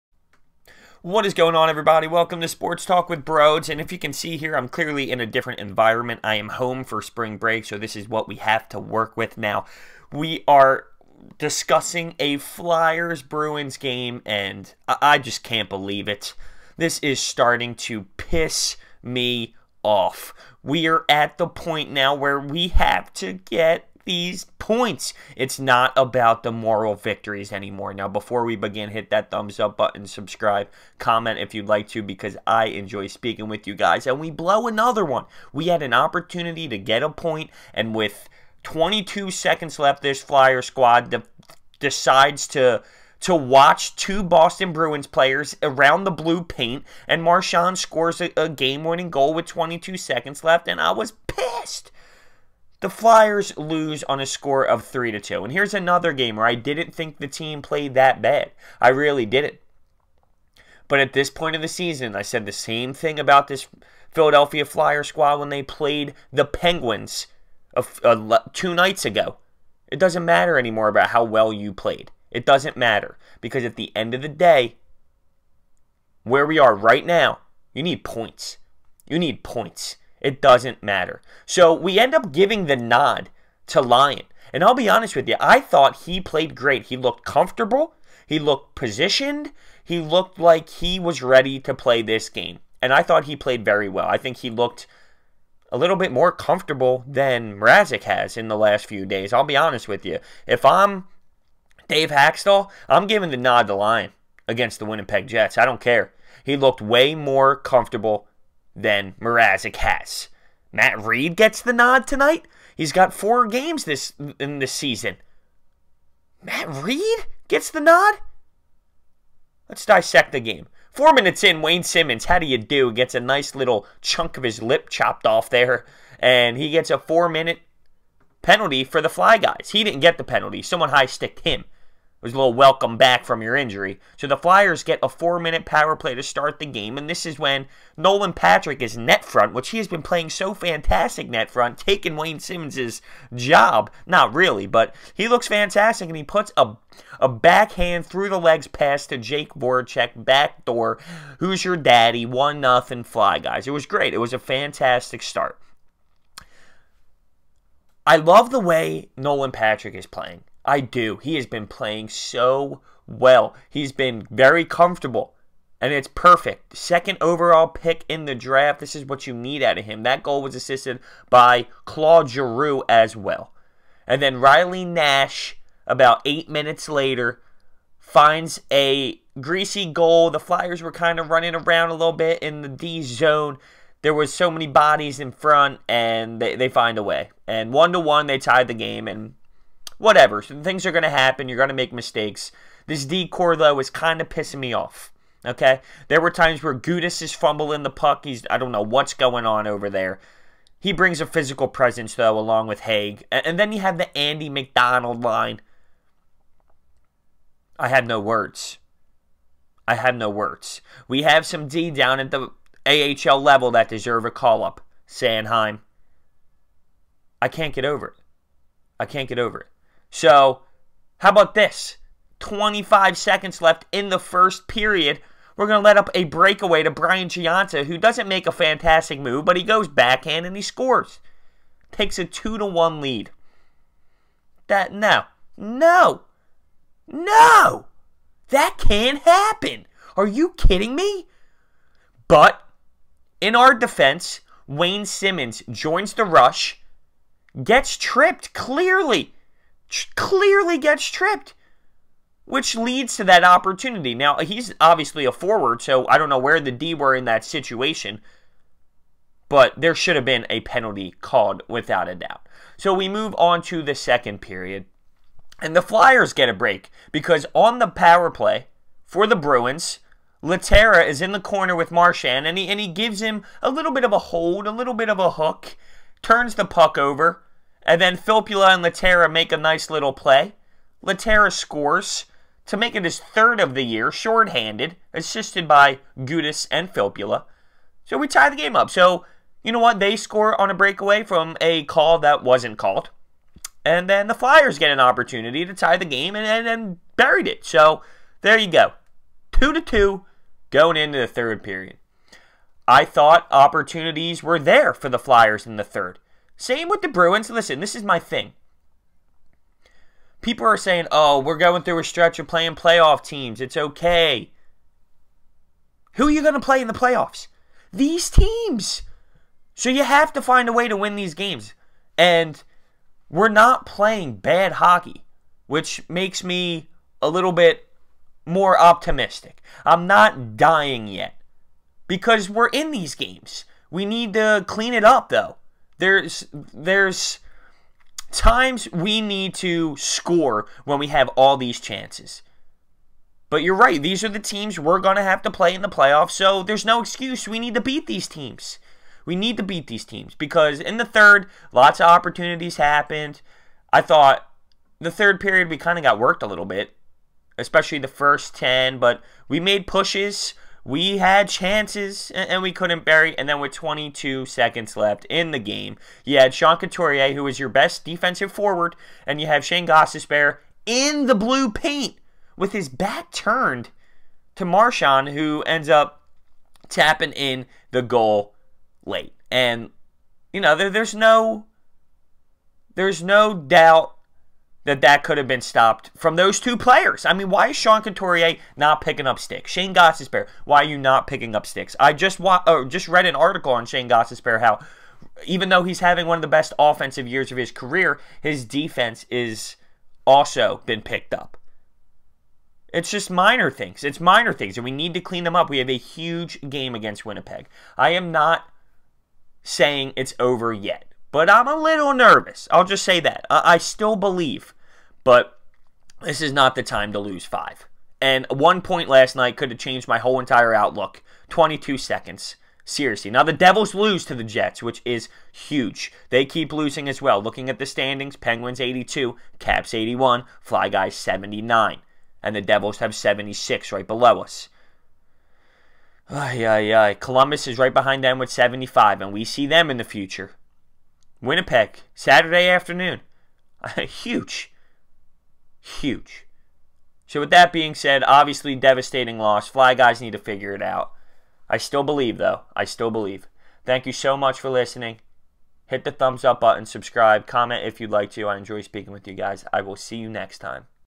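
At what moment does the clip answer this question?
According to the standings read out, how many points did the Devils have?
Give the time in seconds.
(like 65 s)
433 s.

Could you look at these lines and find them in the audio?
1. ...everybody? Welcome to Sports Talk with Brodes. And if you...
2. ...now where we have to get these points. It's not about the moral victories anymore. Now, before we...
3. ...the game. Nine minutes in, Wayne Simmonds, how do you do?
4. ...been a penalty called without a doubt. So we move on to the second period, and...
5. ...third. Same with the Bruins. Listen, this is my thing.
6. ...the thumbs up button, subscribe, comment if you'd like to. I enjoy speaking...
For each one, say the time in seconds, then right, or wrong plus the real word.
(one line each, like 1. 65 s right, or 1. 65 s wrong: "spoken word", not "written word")
1. 1 s right
2. 21 s right
3. 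120 s wrong: "Four", not "Nine"
4. 260 s right
5. 305 s right
6. 456 s right.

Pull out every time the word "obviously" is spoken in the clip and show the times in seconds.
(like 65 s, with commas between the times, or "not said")
254 s, 448 s.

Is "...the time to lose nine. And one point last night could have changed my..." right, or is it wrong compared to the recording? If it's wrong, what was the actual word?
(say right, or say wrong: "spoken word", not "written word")
wrong: "five", not "nine".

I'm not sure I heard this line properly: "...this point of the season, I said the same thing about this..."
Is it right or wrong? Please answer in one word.
right.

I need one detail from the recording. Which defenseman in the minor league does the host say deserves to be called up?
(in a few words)
Sanheim.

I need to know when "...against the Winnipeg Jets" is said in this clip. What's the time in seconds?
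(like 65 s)
104 s.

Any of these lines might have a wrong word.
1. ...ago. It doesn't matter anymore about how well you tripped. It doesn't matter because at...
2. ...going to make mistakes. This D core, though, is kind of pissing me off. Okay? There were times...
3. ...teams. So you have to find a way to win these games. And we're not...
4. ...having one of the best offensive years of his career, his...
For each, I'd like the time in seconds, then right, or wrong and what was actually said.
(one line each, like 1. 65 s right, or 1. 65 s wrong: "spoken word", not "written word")
1. 69 s wrong: "played", not "tripped"
2. 191 s right
3. 318 s right
4. 395 s right.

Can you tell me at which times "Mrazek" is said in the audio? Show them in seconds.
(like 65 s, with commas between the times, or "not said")
97 s, 109 s.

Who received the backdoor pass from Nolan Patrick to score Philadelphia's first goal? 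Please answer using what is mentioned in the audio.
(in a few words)
Jake Voracek.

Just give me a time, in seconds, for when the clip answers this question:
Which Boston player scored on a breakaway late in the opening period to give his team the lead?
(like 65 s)
226 s.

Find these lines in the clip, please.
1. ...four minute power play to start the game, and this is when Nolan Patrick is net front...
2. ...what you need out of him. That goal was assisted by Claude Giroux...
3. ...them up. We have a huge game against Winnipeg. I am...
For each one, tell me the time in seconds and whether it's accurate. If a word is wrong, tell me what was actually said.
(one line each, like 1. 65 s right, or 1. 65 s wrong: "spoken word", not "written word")
1. 135 s right
2. 169 s right
3. 405 s right.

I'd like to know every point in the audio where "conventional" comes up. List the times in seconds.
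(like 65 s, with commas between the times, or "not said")
not said.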